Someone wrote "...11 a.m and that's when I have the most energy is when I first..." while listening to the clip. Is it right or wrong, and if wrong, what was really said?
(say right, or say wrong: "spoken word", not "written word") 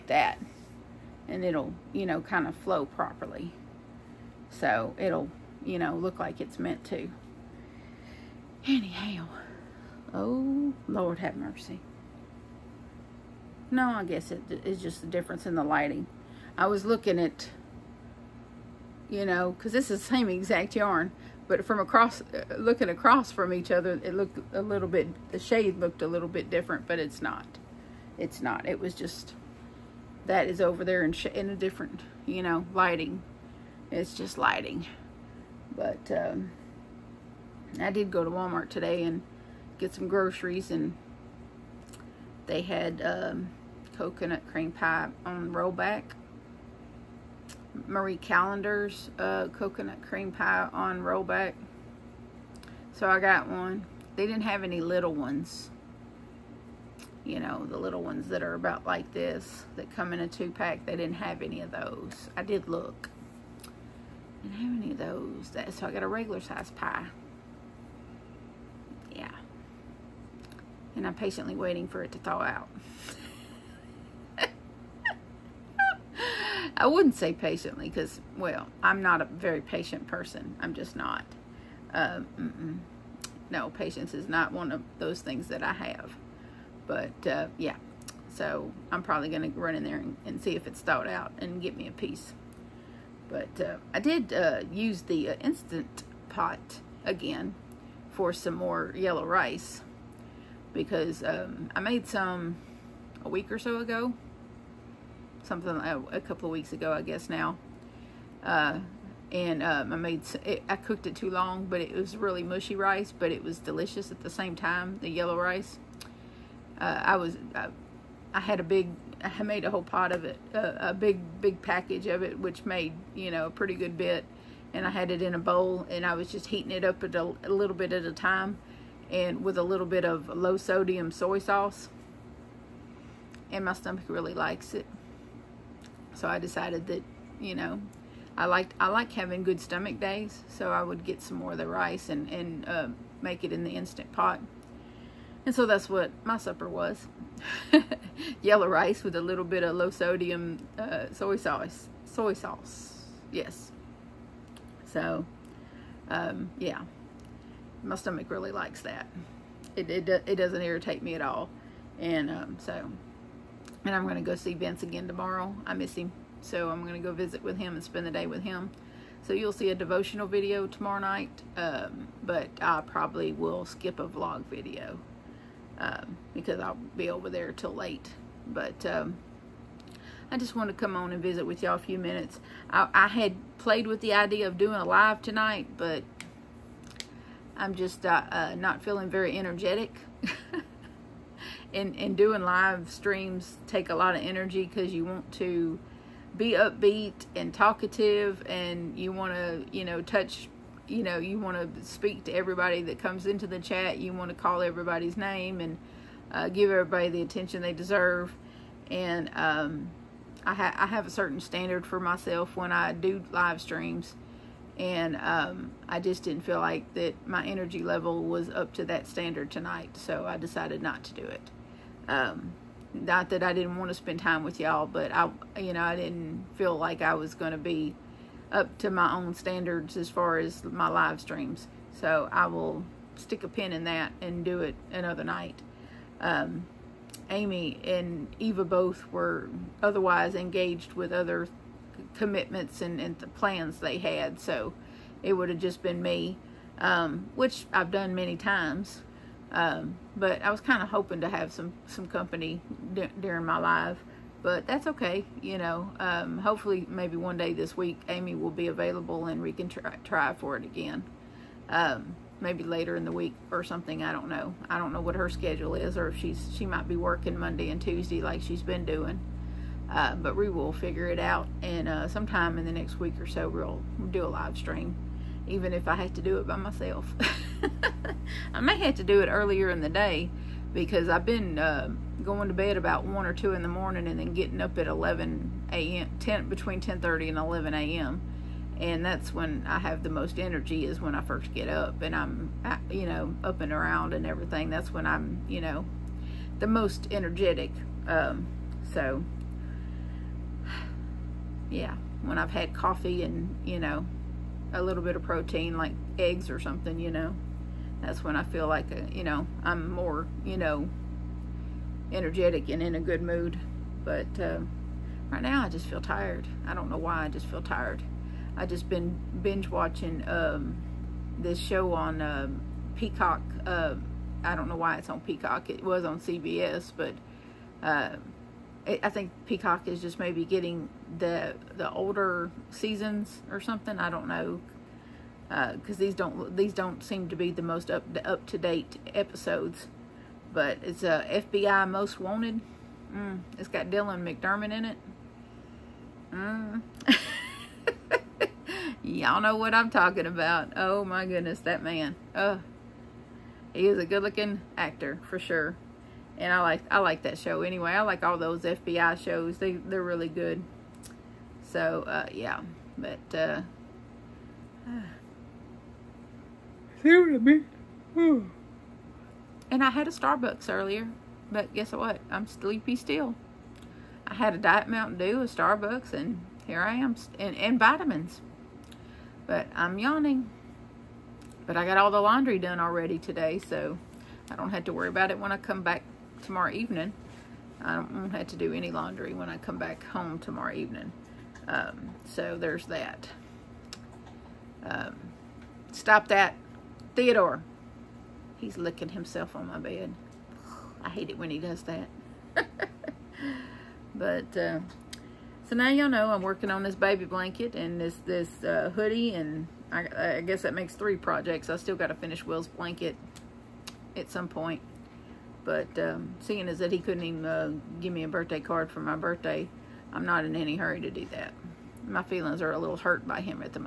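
right.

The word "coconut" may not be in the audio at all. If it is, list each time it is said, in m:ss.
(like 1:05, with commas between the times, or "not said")
0:43, 0:49.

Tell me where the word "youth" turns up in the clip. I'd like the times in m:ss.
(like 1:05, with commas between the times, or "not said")
not said.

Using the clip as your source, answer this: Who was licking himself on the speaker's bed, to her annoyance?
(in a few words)
Theodore.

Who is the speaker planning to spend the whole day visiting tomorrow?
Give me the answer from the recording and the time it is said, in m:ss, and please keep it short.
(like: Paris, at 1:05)
Vince, at 2:44.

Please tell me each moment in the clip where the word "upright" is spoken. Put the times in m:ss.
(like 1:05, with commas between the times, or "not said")
not said.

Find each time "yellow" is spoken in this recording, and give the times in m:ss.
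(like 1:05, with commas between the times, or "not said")
1:38, 1:55, 2:28.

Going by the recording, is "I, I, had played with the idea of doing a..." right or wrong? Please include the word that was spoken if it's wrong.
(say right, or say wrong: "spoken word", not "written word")
right.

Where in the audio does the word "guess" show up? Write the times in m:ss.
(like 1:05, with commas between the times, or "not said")
0:14, 1:47, 6:11, 6:50.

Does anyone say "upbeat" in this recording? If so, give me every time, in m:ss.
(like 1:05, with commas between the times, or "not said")
3:16.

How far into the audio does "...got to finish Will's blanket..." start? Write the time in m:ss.
6:51.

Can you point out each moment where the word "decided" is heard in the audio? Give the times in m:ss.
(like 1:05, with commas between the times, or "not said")
2:16, 3:40.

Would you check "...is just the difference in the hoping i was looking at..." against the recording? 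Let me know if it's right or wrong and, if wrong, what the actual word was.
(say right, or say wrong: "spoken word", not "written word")
wrong: "lighting", not "hoping".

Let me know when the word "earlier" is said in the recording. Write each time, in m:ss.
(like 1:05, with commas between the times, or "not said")
4:39, 6:10.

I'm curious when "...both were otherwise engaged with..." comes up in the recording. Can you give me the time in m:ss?
3:58.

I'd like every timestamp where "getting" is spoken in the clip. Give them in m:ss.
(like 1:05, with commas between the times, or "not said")
4:44, 5:30.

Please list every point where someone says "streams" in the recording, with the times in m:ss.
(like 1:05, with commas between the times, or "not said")
3:12, 3:33, 3:51, 4:34.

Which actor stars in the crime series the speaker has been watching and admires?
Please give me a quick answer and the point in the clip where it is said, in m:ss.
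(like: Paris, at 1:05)
Dylan McDermott, at 5:43.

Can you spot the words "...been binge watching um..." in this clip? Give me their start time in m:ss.
5:18.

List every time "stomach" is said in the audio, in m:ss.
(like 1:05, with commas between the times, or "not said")
2:13, 2:19, 2:37.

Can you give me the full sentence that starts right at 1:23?
No, patience is not one of those things that I have.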